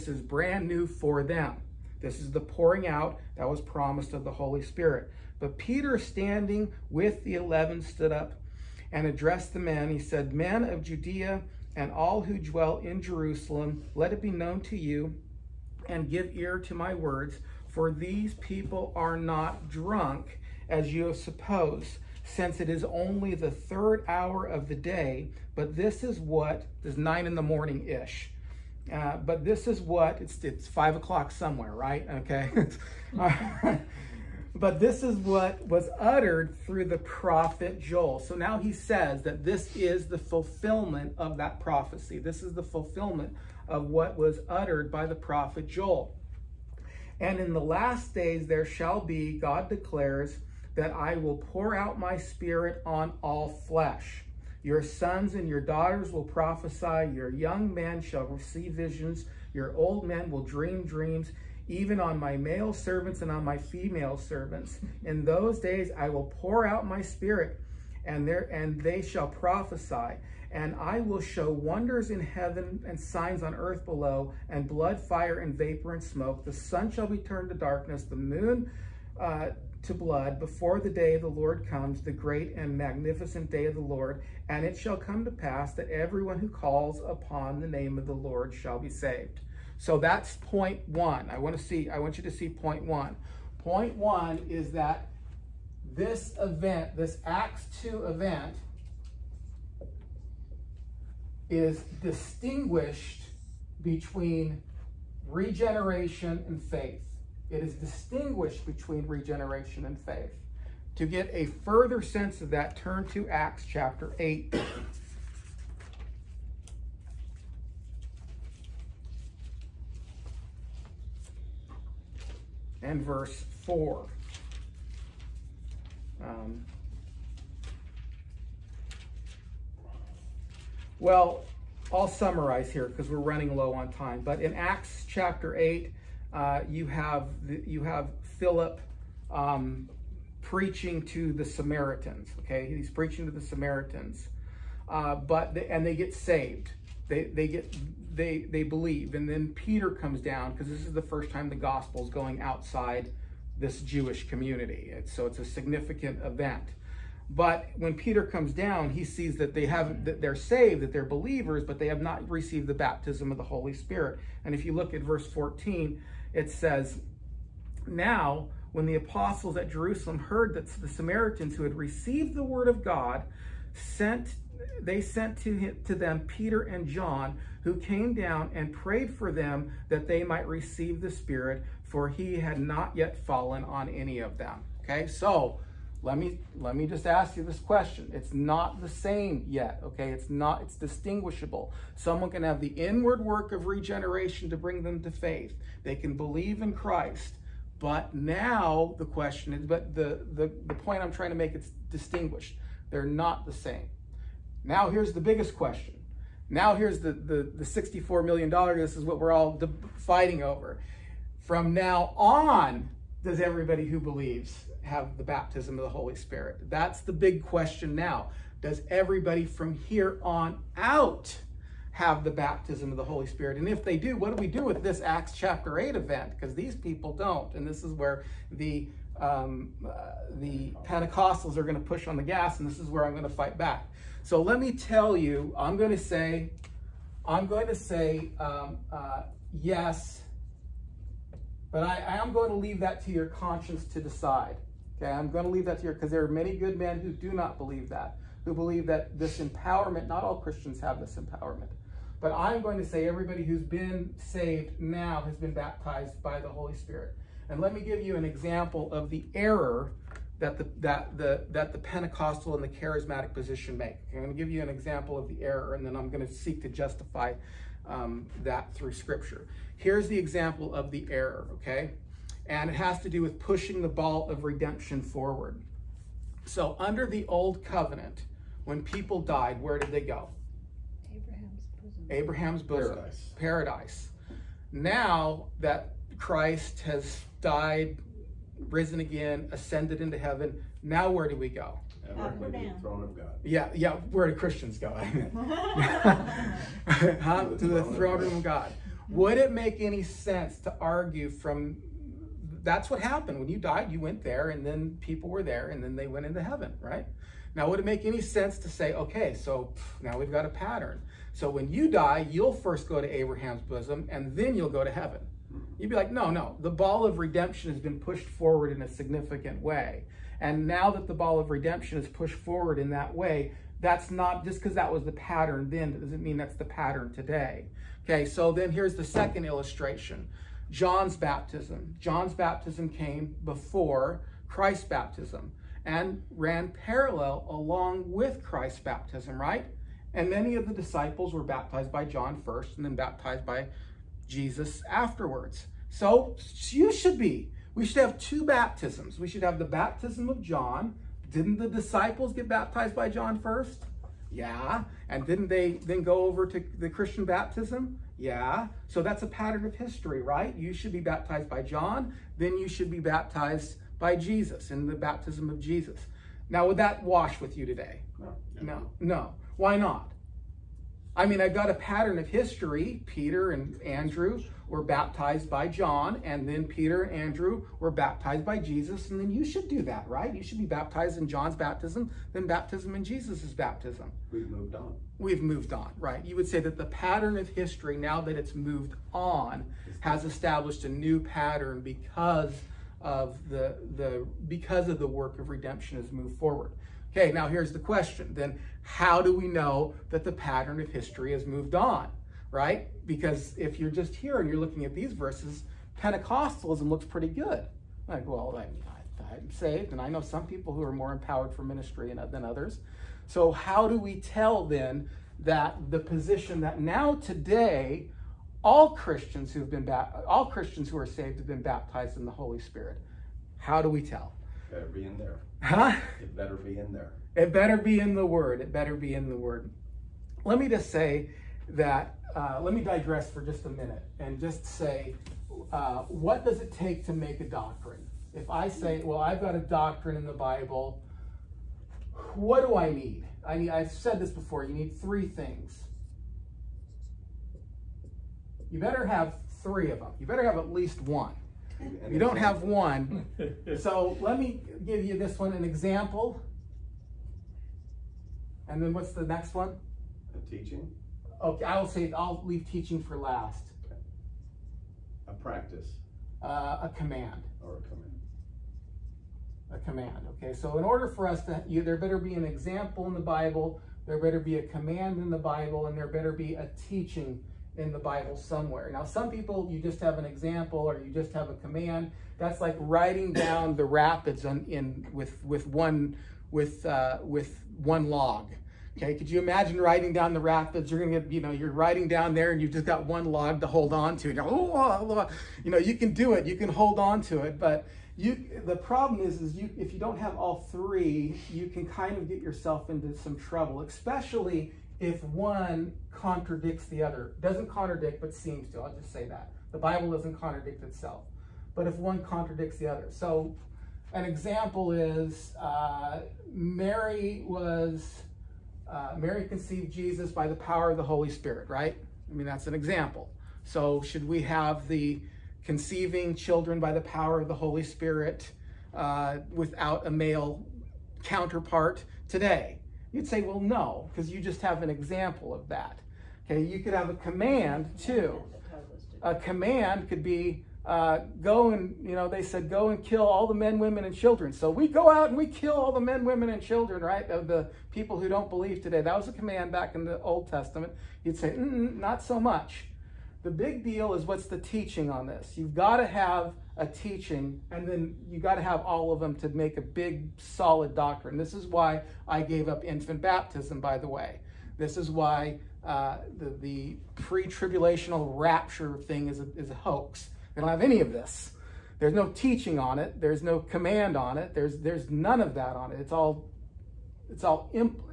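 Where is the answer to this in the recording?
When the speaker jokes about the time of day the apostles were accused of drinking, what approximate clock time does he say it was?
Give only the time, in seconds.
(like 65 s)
26 s.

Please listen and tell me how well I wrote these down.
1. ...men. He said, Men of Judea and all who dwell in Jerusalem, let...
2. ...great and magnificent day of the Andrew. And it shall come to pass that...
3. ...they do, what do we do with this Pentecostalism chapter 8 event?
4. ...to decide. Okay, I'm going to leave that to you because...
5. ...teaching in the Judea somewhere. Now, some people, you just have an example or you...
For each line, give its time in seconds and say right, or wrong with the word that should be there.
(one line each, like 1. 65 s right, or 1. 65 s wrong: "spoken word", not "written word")
1. 9 s right
2. 82 s wrong: "Lord", not "Andrew"
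3. 223 s wrong: "Acts", not "Pentecostalism"
4. 243 s right
5. 476 s wrong: "Bible", not "Judea".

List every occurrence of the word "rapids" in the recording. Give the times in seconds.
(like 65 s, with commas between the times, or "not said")
483 s, 490 s.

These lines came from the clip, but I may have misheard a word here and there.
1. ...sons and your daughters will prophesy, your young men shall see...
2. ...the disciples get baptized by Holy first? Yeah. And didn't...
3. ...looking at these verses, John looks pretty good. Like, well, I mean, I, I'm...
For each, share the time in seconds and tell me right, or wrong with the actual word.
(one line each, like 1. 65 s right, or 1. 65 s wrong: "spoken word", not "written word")
1. 54 s right
2. 351 s wrong: "John", not "Holy"
3. 404 s wrong: "Pentecostalism", not "John".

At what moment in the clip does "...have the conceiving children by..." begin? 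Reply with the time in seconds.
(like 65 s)
524 s.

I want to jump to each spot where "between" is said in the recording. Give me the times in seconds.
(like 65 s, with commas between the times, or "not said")
103 s, 108 s.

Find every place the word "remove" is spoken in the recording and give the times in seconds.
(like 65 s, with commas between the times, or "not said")
not said.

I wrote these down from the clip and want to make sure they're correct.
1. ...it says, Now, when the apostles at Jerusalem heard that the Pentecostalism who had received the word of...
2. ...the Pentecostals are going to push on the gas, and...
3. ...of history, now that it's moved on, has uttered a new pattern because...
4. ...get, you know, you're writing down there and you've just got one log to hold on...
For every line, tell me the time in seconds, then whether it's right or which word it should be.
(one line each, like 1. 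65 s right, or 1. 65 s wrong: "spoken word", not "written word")
1. 166 s wrong: "Samaritans", not "Pentecostalism"
2. 230 s right
3. 387 s wrong: "established", not "uttered"
4. 491 s right.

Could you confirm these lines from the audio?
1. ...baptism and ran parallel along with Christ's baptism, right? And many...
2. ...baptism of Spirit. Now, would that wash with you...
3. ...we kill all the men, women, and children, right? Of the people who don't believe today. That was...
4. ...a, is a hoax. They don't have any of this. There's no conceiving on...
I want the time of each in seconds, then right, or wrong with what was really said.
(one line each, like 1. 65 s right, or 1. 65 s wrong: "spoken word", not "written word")
1. 334 s right
2. 364 s wrong: "Jesus", not "Spirit"
3. 545 s right
4. 569 s wrong: "teaching", not "conceiving".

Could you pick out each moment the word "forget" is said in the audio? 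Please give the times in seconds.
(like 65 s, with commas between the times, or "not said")
not said.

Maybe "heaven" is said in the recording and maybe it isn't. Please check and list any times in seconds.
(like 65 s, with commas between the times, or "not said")
72 s, 290 s, 306 s, 314 s.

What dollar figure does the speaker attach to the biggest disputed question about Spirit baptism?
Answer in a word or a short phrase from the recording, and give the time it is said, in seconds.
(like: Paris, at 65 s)
$64 million, at 207 s.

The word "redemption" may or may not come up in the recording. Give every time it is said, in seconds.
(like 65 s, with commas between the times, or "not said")
274 s, 317 s, 321 s, 395 s.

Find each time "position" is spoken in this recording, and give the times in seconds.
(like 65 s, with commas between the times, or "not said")
263 s, 415 s.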